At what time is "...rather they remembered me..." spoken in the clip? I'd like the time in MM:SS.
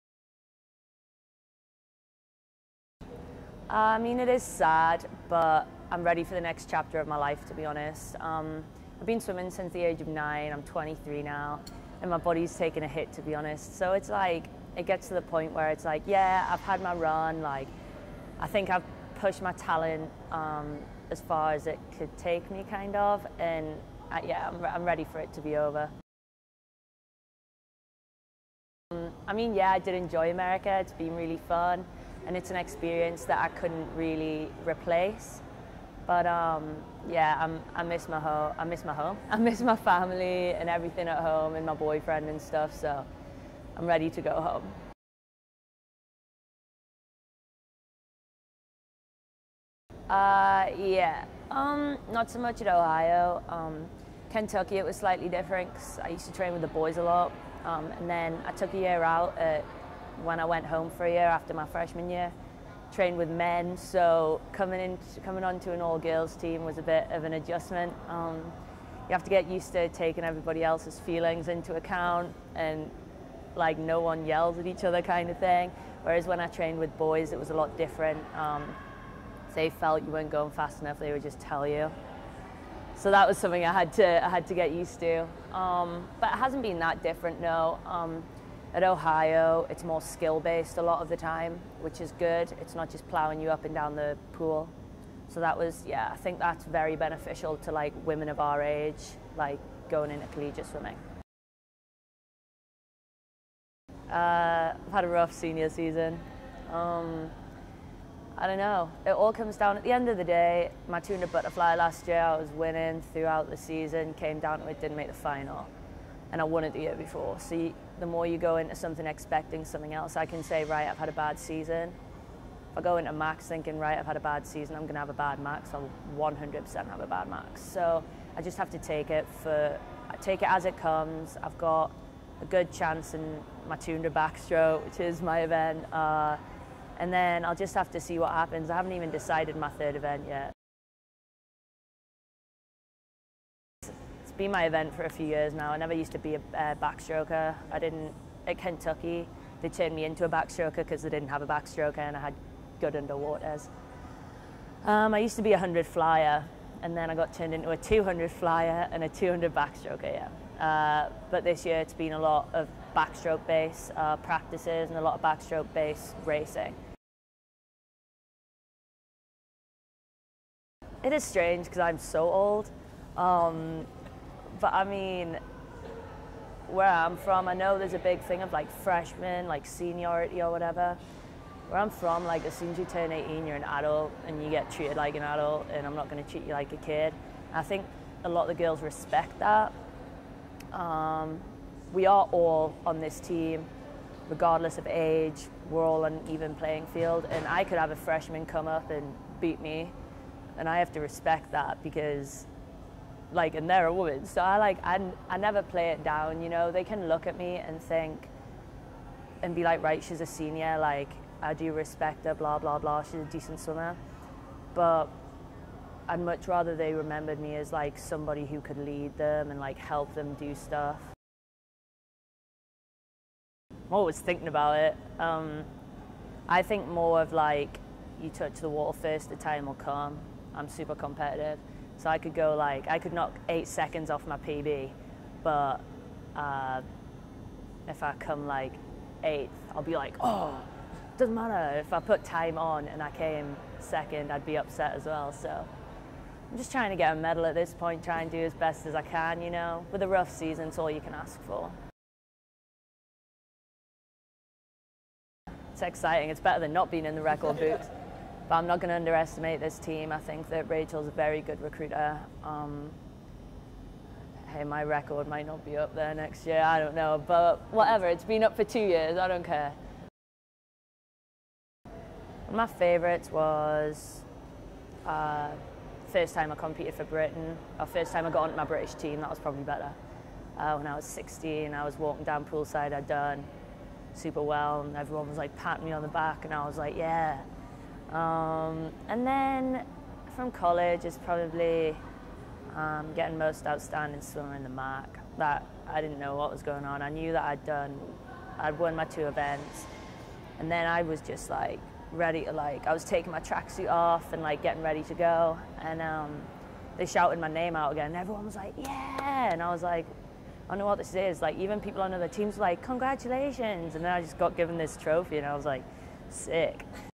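03:36.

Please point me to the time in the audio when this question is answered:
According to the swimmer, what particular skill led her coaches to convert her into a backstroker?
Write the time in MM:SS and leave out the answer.
02:32.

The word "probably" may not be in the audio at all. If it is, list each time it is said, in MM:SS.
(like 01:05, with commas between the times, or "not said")
04:39, 04:51.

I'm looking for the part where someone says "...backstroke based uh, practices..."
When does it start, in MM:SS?
02:42.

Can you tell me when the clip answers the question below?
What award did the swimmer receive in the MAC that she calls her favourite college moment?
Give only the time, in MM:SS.
04:53.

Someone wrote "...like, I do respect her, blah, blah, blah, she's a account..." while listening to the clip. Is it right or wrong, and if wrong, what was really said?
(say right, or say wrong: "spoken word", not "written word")
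wrong: "decent", not "account".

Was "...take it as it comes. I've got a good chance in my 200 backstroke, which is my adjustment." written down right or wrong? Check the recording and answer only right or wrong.
wrong.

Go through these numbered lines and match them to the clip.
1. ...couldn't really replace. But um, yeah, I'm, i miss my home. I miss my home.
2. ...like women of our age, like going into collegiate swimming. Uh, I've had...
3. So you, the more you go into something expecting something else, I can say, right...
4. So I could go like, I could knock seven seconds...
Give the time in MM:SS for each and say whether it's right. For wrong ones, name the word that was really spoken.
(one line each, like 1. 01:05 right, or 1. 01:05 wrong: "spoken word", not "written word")
1. 00:33 right
2. 01:37 right
3. 01:57 right
4. 03:52 wrong: "eight", not "seven".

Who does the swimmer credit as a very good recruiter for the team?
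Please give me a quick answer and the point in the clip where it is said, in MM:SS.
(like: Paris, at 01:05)
Rachel, at 04:20.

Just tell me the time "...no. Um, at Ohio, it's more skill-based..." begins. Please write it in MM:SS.
01:27.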